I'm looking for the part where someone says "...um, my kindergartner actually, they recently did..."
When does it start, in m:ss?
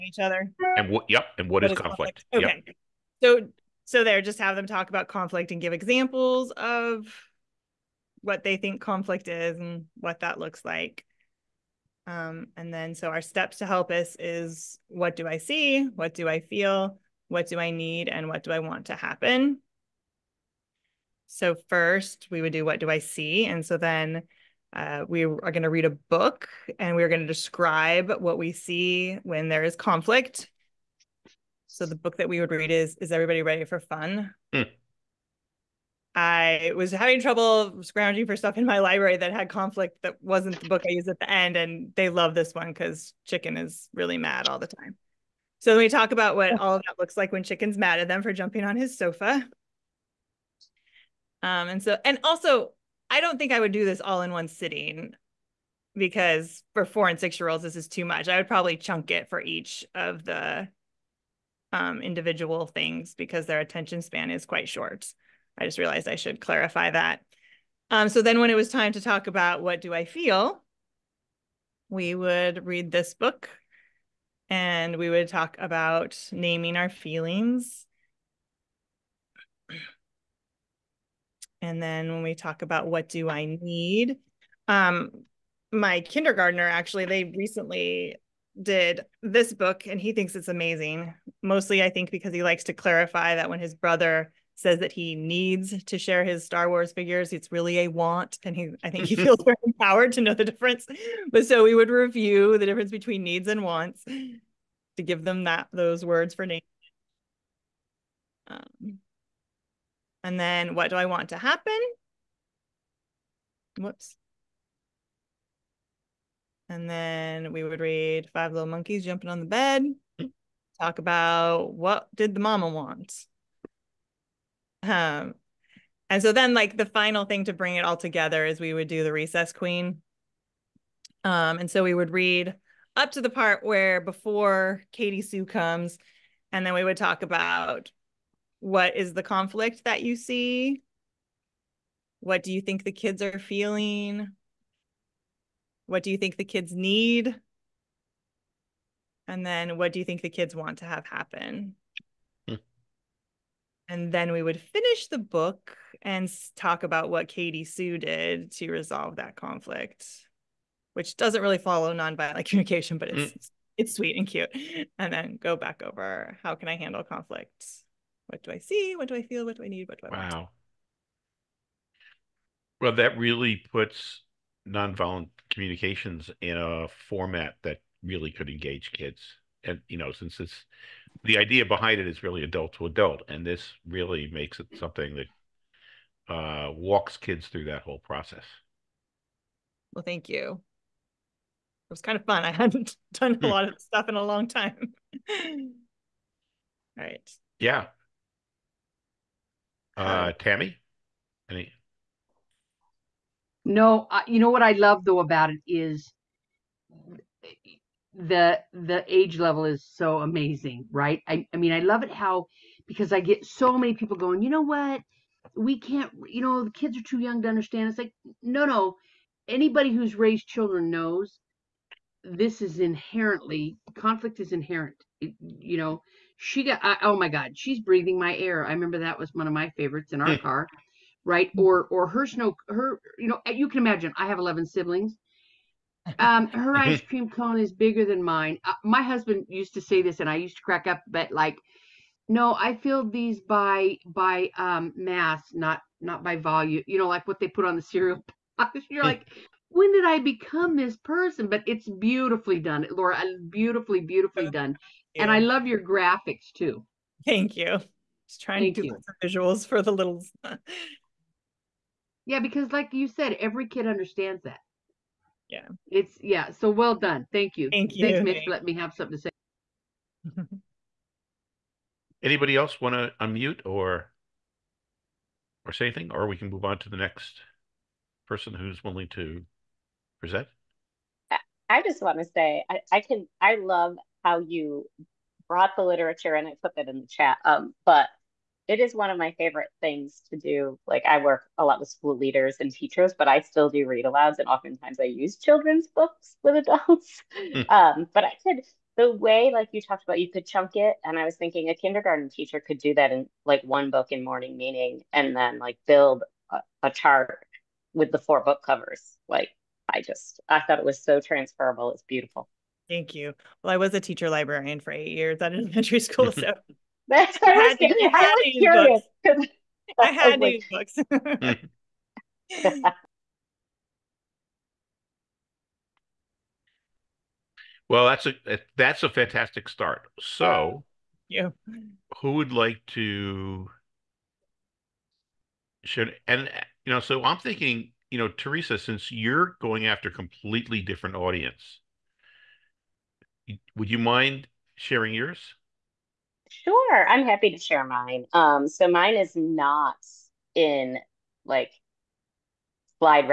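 1:24.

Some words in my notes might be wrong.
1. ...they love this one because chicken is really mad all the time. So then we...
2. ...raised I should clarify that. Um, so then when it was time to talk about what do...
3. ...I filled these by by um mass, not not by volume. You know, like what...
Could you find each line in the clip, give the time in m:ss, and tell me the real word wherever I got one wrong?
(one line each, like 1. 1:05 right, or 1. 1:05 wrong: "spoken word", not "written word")
1. 0:41 right
2. 1:05 wrong: "realized", not "raised"
3. 4:02 right.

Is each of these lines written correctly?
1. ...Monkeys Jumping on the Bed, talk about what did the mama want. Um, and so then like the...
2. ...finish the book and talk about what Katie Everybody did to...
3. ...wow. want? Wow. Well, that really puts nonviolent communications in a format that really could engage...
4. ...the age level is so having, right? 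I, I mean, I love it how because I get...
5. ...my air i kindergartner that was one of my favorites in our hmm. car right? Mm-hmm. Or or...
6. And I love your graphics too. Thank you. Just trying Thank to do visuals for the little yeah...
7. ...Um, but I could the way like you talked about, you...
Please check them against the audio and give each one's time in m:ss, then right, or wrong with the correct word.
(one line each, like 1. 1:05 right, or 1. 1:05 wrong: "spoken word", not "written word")
1. 1:58 right
2. 2:34 wrong: "Sue", not "Everybody"
3. 2:50 right
4. 3:28 wrong: "amazing", not "having"
5. 3:48 wrong: "remember", not "kindergartner"
6. 4:15 right
7. 4:57 right.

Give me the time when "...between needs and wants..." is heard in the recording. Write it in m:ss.
1:42.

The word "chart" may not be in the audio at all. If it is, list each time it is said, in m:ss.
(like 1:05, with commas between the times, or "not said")
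5:06.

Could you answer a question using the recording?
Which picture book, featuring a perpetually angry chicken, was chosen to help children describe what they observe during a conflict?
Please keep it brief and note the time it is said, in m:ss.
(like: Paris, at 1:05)
Is Everybody Ready for Fun?, at 0:32.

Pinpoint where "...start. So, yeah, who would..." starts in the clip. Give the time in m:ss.
5:29.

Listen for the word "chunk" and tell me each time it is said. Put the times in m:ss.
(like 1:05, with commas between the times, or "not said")
0:58, 5:00.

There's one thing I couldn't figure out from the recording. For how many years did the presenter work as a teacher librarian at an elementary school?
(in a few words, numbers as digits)
8.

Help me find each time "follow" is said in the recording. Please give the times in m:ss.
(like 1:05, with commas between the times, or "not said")
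2:41.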